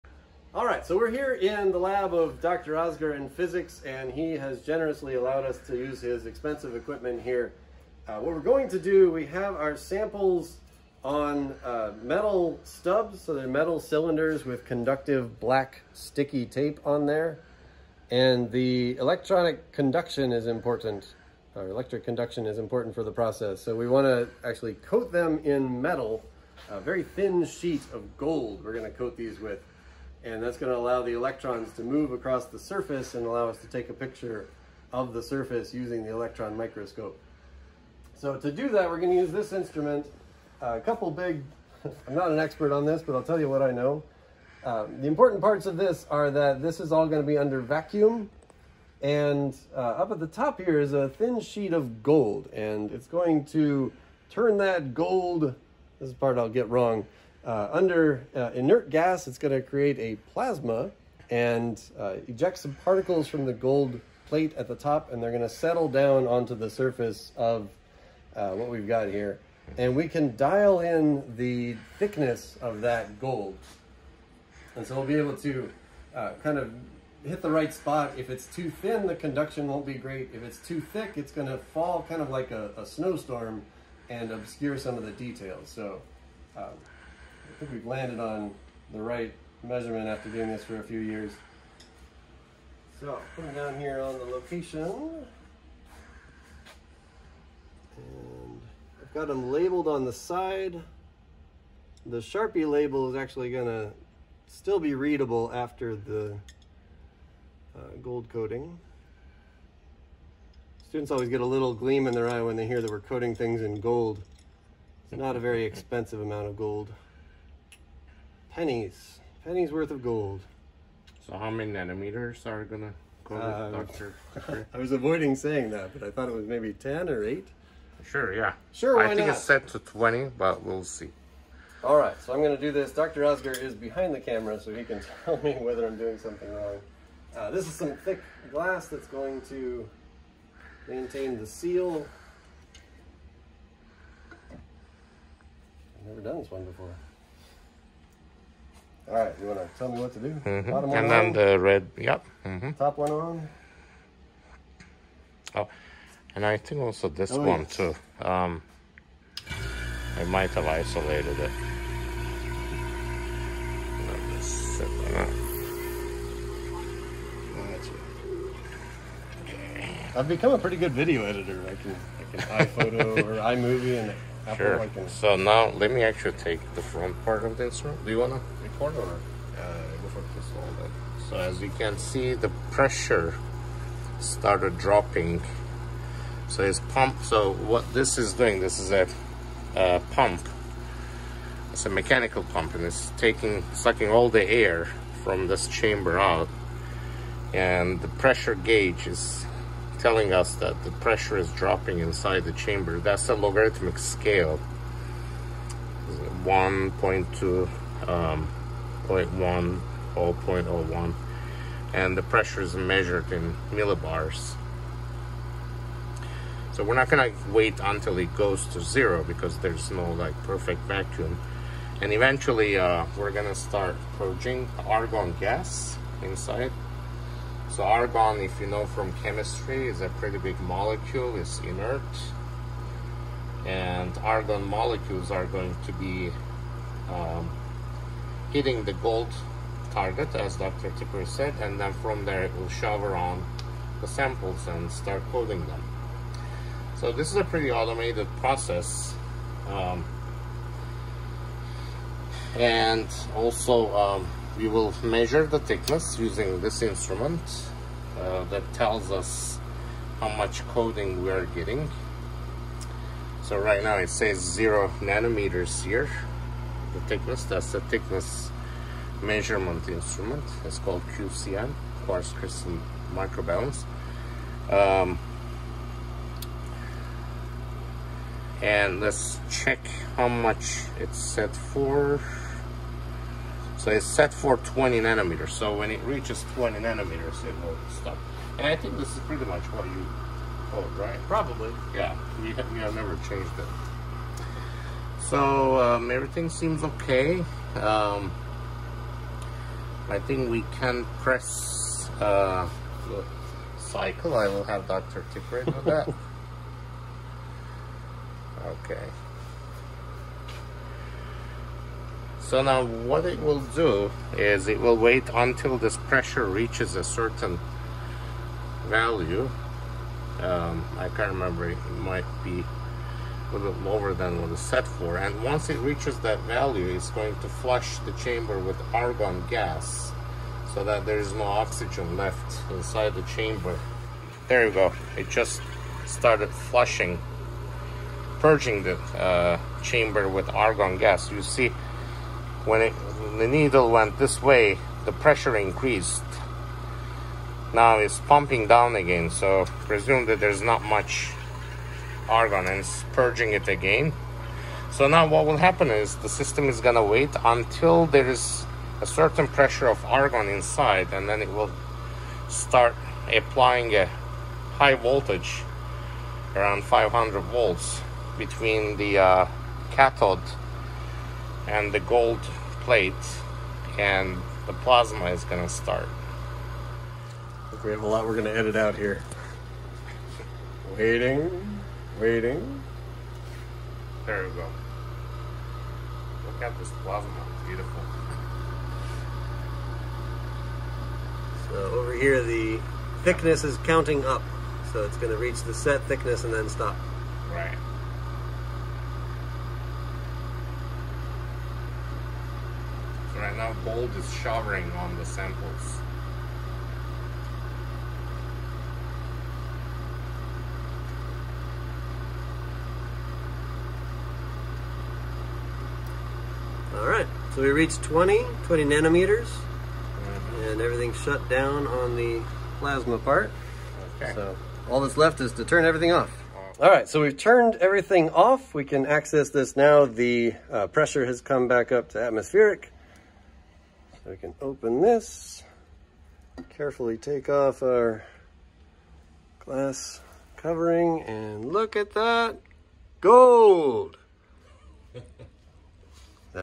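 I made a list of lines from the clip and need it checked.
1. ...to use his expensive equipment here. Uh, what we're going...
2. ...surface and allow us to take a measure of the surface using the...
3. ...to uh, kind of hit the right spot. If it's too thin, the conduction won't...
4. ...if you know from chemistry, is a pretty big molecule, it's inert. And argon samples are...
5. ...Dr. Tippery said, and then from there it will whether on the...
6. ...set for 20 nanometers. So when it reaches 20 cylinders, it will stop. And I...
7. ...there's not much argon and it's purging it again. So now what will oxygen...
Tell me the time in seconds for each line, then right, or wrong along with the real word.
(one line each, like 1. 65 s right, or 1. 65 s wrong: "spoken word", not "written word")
1. 5 s right
2. 32 s wrong: "picture", not "measure"
3. 75 s right
4. 228 s wrong: "molecules", not "samples"
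5. 240 s wrong: "shower", not "whether"
6. 284 s wrong: "nanometers", not "cylinders"
7. 350 s wrong: "happen", not "oxygen".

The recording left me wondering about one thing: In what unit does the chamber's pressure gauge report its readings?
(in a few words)
millibars.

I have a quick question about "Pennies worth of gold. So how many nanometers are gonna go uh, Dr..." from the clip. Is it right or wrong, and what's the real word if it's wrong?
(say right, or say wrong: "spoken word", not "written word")
right.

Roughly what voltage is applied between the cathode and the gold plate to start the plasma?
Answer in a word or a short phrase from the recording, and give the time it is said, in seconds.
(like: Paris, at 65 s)
500 volts, at 366 s.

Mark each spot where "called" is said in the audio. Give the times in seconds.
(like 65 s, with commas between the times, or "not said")
270 s.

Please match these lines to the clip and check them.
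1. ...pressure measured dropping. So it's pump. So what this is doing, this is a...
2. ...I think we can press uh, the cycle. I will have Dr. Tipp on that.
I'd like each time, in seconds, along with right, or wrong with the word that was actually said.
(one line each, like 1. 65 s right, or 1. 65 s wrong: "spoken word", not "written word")
1. 182 s wrong: "started", not "measured"
2. 300 s right.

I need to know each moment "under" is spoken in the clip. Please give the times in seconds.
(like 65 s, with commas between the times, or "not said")
47 s, 57 s.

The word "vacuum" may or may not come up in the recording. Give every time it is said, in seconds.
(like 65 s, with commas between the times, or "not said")
47 s, 220 s.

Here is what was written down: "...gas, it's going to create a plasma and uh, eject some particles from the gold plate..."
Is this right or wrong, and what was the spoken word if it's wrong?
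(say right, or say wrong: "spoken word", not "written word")
right.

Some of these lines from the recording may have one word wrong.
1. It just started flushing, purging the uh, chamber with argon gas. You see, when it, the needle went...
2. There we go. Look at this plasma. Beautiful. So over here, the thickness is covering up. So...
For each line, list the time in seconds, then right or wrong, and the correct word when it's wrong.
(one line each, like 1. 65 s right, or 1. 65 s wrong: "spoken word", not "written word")
1. 335 s right
2. 384 s wrong: "counting", not "covering".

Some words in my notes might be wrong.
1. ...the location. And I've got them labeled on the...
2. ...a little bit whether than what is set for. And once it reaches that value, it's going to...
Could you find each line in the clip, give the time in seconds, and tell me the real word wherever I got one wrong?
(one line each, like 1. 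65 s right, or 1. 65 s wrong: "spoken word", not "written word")
1. 94 s right
2. 322 s wrong: "lower", not "whether".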